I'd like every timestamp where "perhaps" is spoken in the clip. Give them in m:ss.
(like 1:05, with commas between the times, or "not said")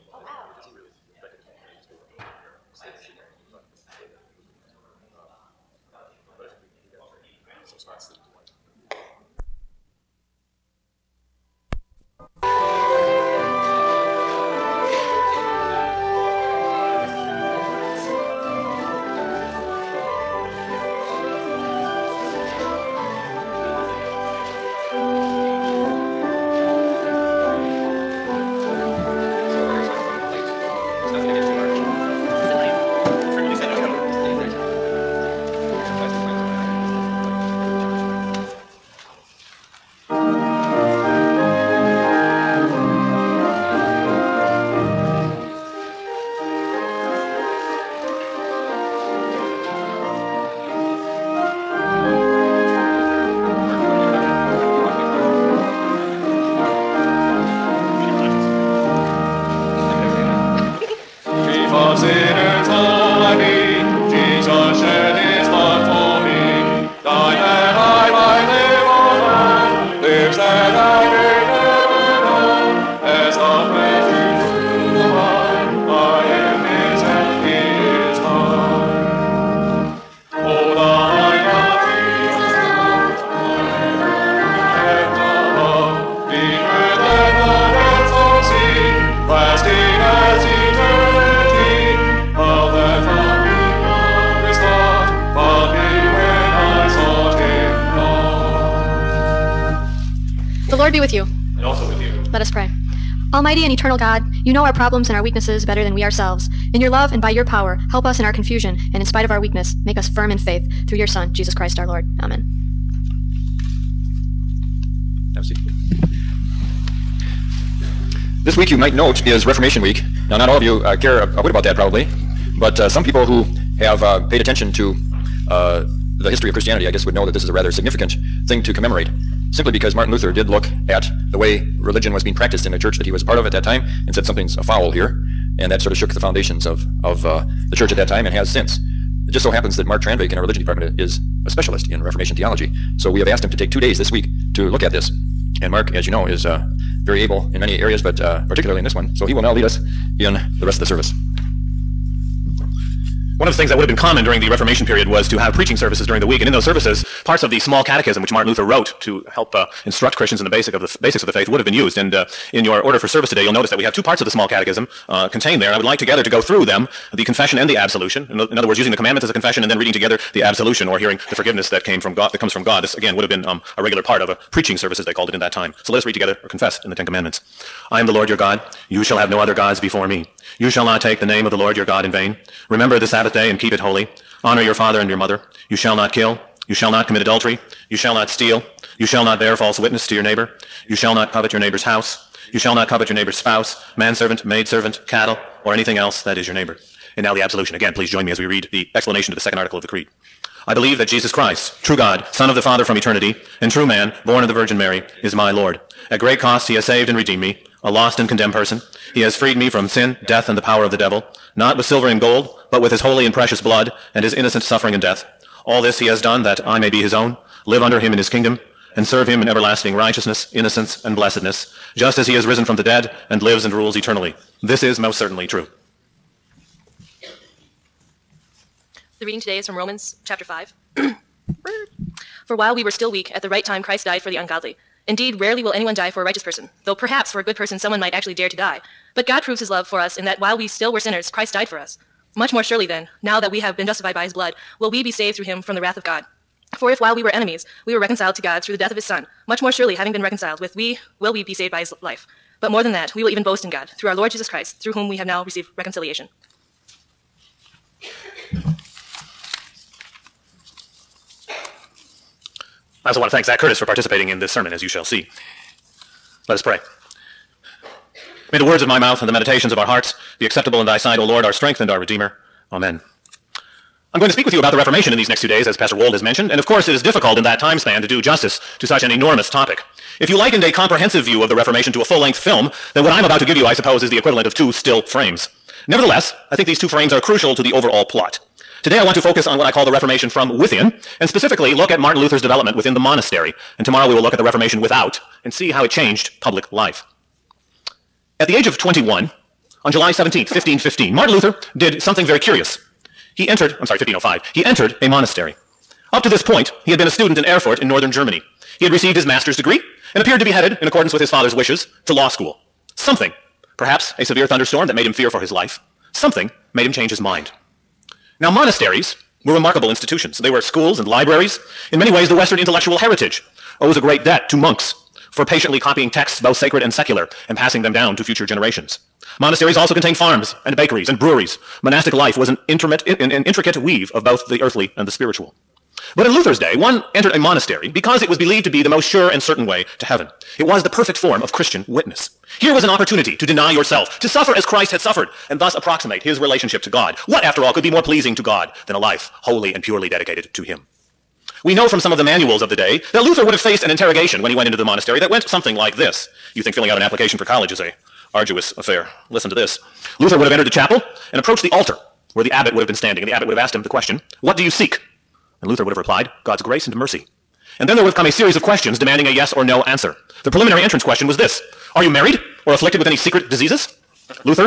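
3:56, 5:13.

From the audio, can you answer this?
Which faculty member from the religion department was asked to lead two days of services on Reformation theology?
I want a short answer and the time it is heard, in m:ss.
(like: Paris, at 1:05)
Mark Tranvik, at 2:19.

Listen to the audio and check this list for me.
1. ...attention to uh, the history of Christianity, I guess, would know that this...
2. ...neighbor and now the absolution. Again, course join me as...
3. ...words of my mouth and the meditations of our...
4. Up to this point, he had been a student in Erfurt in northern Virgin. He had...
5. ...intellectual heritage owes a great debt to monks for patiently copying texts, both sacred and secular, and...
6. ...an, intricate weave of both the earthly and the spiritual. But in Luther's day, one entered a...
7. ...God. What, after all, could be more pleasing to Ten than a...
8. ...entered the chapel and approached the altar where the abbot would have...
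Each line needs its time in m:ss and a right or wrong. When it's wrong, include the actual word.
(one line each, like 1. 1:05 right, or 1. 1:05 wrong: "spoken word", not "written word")
1. 2:04 right
2. 3:16 wrong: "please", not "course"
3. 4:28 right
4. 5:06 wrong: "Germany", not "Virgin"
5. 5:22 right
6. 5:32 right
7. 5:46 wrong: "God", not "Ten"
8. 6:00 right.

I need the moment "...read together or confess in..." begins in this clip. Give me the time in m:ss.
2:56.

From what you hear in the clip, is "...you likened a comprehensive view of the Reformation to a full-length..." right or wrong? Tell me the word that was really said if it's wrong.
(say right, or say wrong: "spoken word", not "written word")
right.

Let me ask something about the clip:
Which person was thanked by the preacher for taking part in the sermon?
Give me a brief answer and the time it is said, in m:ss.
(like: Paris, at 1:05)
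Zach Curtis, at 4:23.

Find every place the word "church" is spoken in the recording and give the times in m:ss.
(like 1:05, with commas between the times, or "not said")
2:12, 2:17.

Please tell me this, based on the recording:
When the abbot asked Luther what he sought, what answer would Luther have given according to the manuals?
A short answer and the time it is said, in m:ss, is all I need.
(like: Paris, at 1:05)
God's grace and mercy, at 6:06.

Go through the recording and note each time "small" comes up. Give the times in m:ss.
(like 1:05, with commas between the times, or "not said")
2:37, 2:44.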